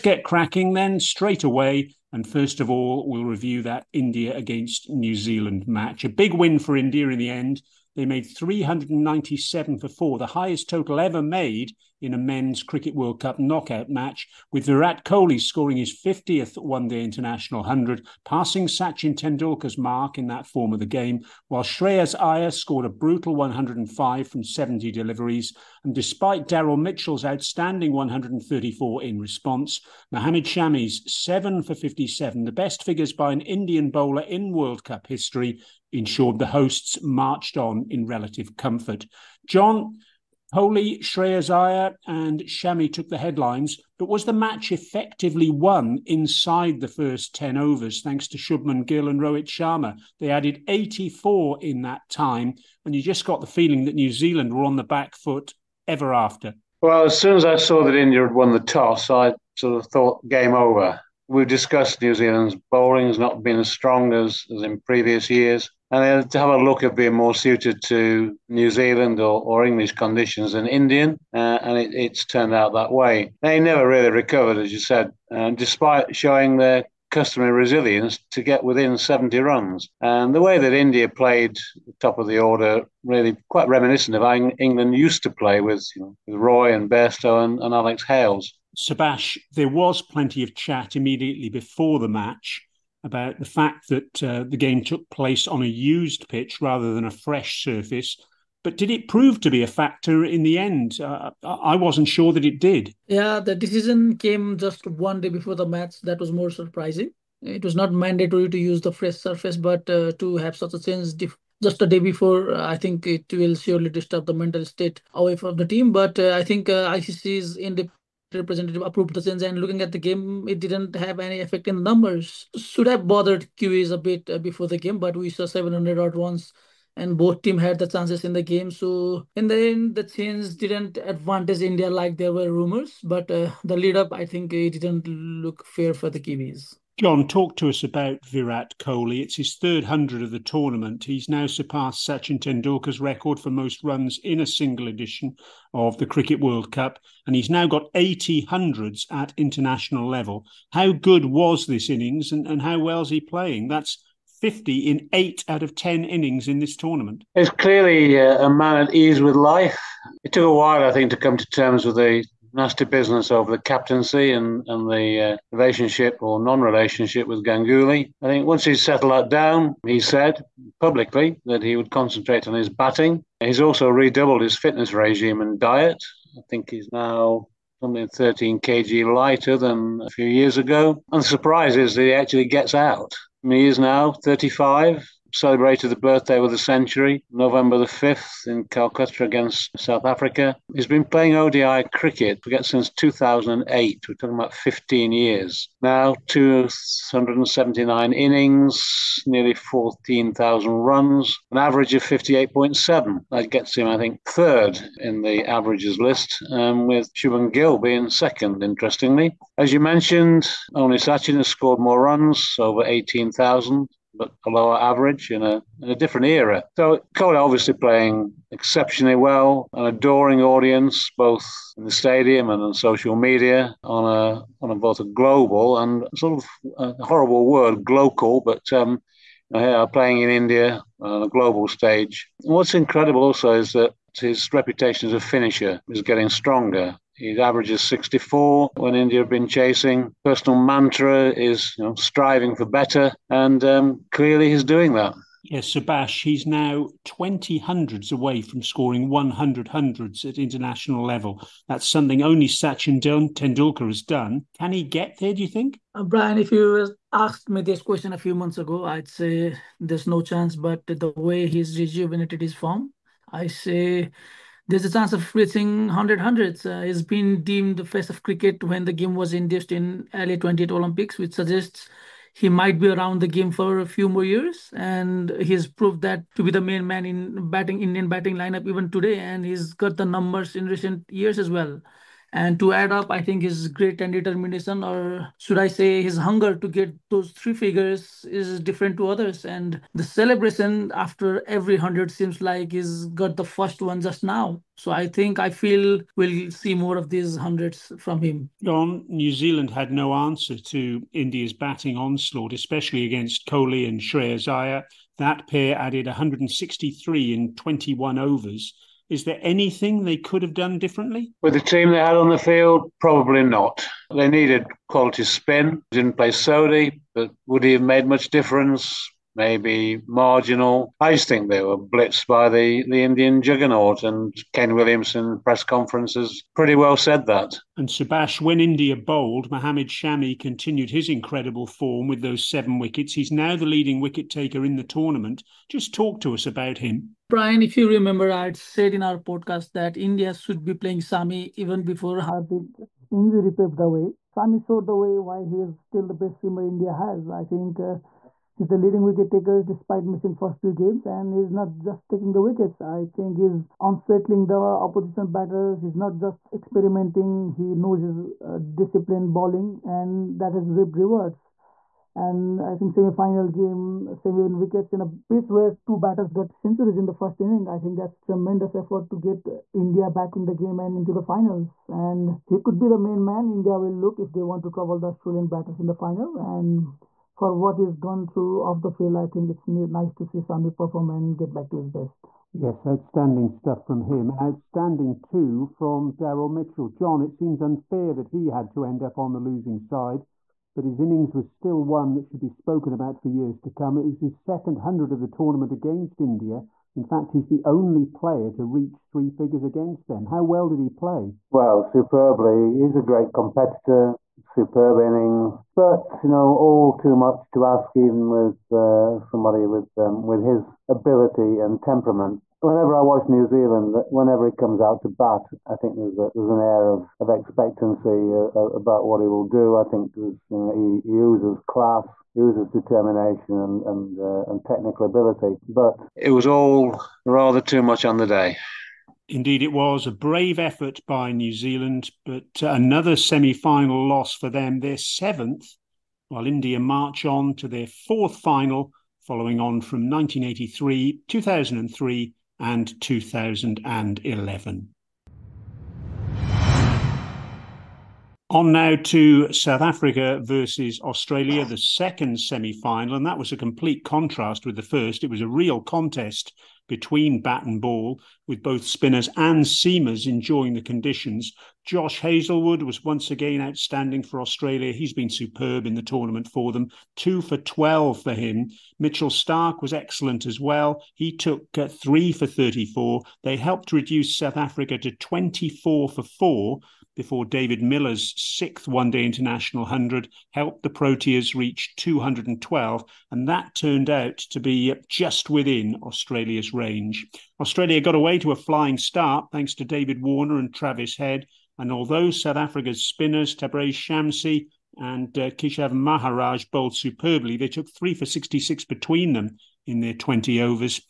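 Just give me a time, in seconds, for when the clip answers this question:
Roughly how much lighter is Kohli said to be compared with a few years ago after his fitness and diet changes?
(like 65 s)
178 s.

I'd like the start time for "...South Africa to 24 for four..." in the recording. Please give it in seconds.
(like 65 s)
474 s.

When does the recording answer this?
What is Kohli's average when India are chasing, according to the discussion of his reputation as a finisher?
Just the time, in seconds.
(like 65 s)
237 s.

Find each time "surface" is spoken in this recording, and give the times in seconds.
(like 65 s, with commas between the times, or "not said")
97 s, 109 s.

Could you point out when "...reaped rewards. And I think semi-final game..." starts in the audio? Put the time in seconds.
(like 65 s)
360 s.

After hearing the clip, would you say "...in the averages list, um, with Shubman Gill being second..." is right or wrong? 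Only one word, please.
right.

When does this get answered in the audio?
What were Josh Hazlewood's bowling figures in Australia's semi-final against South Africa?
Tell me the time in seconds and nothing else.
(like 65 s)
467 s.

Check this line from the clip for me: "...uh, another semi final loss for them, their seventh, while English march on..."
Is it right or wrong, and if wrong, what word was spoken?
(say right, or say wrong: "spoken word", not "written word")
wrong: "India", not "English".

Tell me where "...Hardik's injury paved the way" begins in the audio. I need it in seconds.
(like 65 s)
342 s.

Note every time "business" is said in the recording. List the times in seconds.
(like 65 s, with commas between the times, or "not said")
162 s.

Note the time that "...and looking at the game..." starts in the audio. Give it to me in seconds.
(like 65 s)
119 s.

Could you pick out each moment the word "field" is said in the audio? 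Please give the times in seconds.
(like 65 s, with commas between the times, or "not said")
312 s, 378 s.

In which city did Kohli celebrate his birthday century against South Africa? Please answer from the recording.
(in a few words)
Calcutta.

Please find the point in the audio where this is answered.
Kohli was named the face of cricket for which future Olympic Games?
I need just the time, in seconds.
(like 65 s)
270 s.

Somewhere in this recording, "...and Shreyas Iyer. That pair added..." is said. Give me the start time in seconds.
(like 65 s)
303 s.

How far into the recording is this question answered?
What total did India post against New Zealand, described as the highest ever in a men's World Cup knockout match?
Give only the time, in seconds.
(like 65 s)
8 s.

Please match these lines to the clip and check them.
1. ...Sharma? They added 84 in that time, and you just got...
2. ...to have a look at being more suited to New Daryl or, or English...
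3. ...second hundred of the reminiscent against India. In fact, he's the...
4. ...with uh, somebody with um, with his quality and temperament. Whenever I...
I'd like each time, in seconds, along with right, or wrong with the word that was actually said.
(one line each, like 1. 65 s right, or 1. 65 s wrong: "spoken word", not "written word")
1. 49 s right
2. 66 s wrong: "Zealand", not "Daryl"
3. 394 s wrong: "tournament", not "reminiscent"
4. 408 s wrong: "ability", not "quality".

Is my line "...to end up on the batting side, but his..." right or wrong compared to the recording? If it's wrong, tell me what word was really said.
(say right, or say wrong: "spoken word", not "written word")
wrong: "losing", not "batting".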